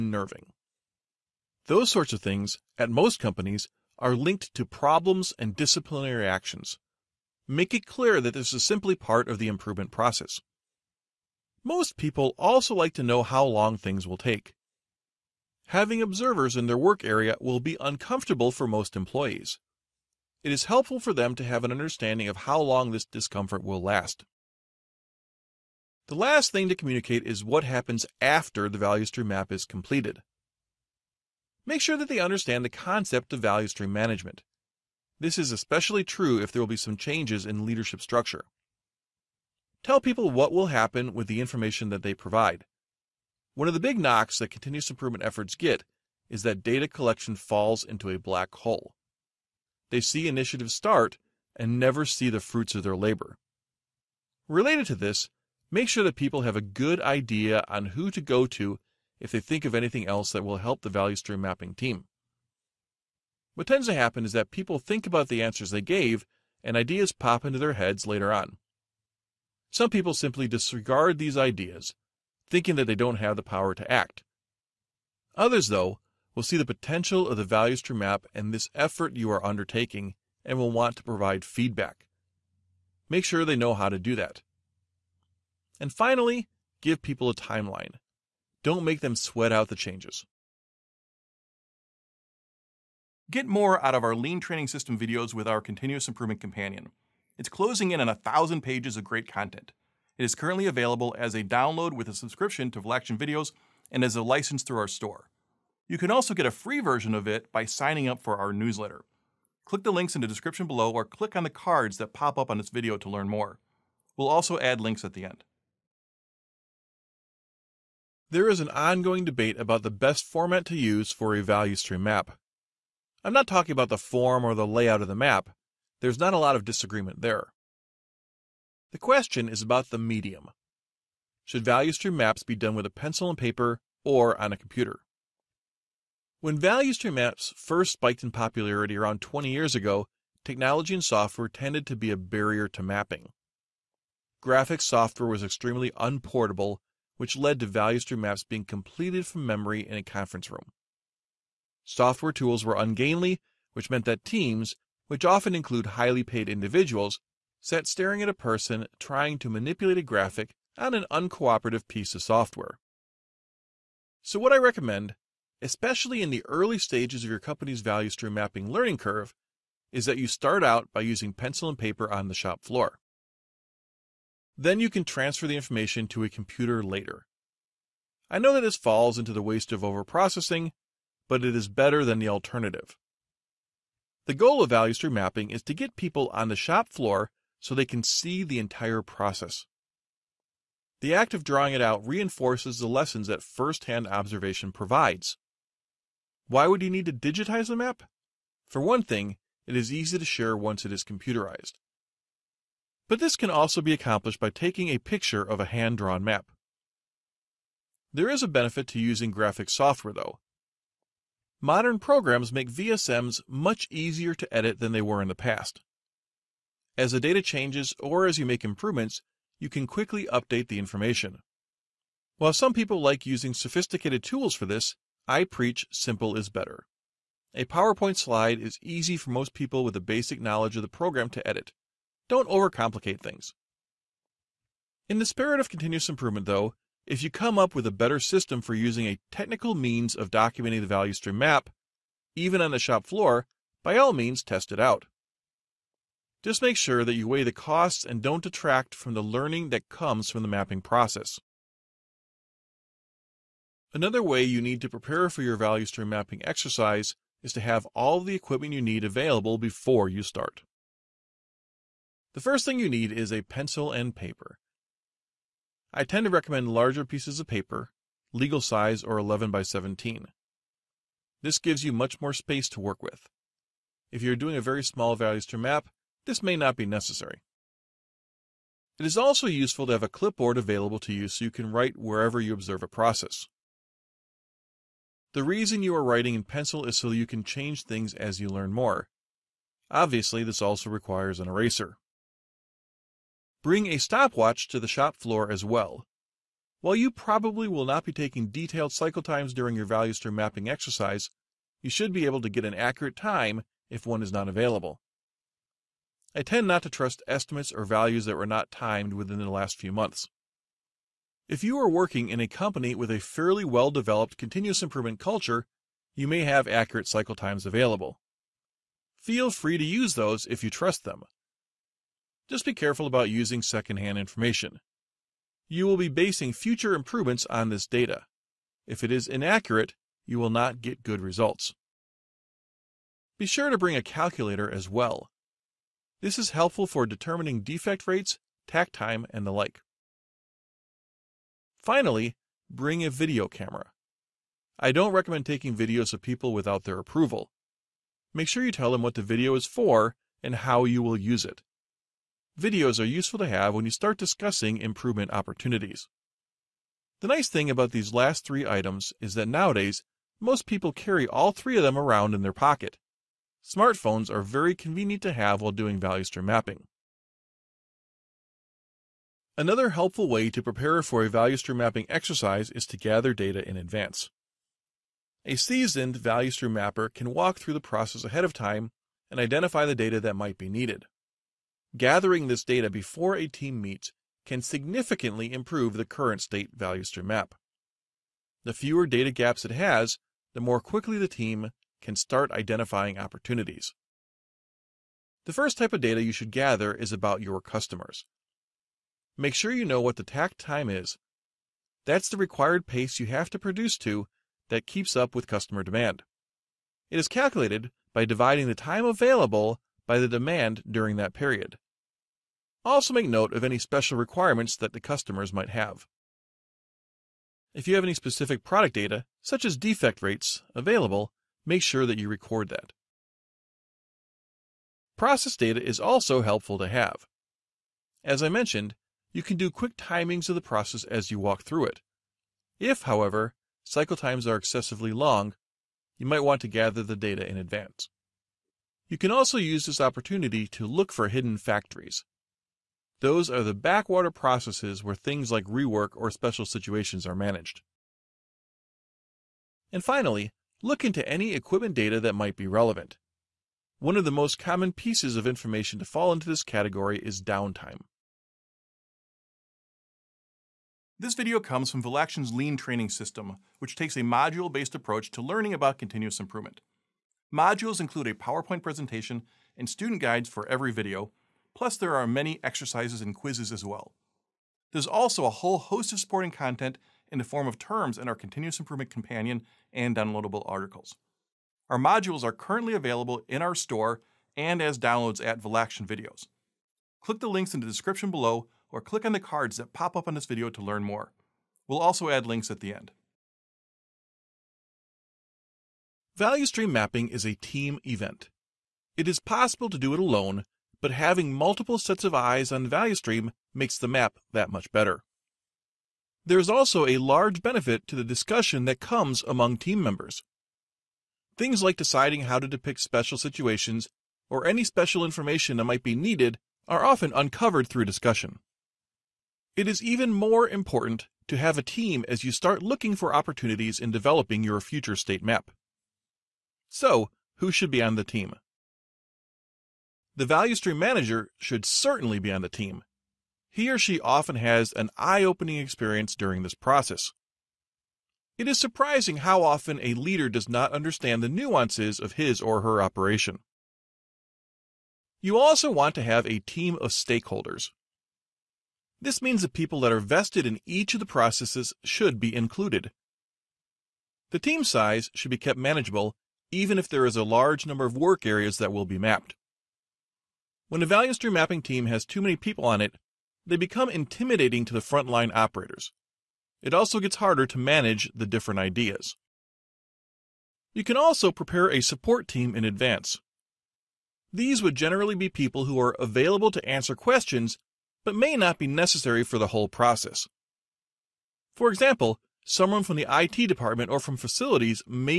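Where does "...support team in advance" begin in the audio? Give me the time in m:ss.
9:32.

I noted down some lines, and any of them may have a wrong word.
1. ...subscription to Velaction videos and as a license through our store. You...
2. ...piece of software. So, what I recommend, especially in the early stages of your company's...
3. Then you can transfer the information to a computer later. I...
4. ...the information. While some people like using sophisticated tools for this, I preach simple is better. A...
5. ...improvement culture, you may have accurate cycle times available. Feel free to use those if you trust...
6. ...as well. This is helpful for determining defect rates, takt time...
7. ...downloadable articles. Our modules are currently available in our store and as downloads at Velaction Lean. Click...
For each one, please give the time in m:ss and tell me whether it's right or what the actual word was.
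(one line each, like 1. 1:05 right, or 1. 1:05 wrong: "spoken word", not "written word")
1. 1:42 right
2. 2:41 right
3. 2:54 right
4. 3:40 right
5. 5:14 right
6. 5:34 right
7. 8:00 wrong: "Videos", not "Lean".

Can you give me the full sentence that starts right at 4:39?
It is also useful to have a clipboard available to you so you can write wherever you observe a process.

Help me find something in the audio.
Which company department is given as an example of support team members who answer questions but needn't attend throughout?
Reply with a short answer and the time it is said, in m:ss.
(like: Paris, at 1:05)
IT department, at 9:43.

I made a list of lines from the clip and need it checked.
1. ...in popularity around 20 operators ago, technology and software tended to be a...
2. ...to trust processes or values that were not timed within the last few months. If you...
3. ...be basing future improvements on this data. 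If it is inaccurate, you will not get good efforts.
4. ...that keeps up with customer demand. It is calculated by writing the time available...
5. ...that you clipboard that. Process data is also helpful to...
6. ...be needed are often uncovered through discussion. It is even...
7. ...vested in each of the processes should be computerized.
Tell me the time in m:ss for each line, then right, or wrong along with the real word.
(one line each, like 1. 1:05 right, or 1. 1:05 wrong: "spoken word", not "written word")
1. 2:18 wrong: "years", not "operators"
2. 5:06 wrong: "estimates", not "processes"
3. 5:25 wrong: "results", not "efforts"
4. 6:44 wrong: "dividing", not "writing"
5. 7:02 wrong: "record", not "clipboard"
6. 8:36 right
7. 9:10 wrong: "included", not "computerized".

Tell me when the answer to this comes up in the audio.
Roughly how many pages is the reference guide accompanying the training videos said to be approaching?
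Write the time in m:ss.
1:38.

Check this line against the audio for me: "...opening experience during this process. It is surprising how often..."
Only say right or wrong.
right.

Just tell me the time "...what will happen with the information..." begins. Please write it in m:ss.
0:40.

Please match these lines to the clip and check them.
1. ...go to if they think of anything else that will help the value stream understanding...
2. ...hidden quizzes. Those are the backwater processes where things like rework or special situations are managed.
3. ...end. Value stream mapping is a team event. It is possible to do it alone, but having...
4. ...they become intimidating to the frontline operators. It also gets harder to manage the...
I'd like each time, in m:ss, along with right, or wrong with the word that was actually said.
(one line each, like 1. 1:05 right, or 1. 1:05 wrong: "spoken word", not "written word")
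1. 0:58 wrong: "mapping", not "understanding"
2. 7:21 wrong: "factories", not "quizzes"
3. 8:12 right
4. 9:23 right.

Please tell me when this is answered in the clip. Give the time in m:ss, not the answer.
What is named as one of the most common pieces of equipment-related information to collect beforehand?
7:37.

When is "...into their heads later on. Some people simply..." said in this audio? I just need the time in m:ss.
1:07.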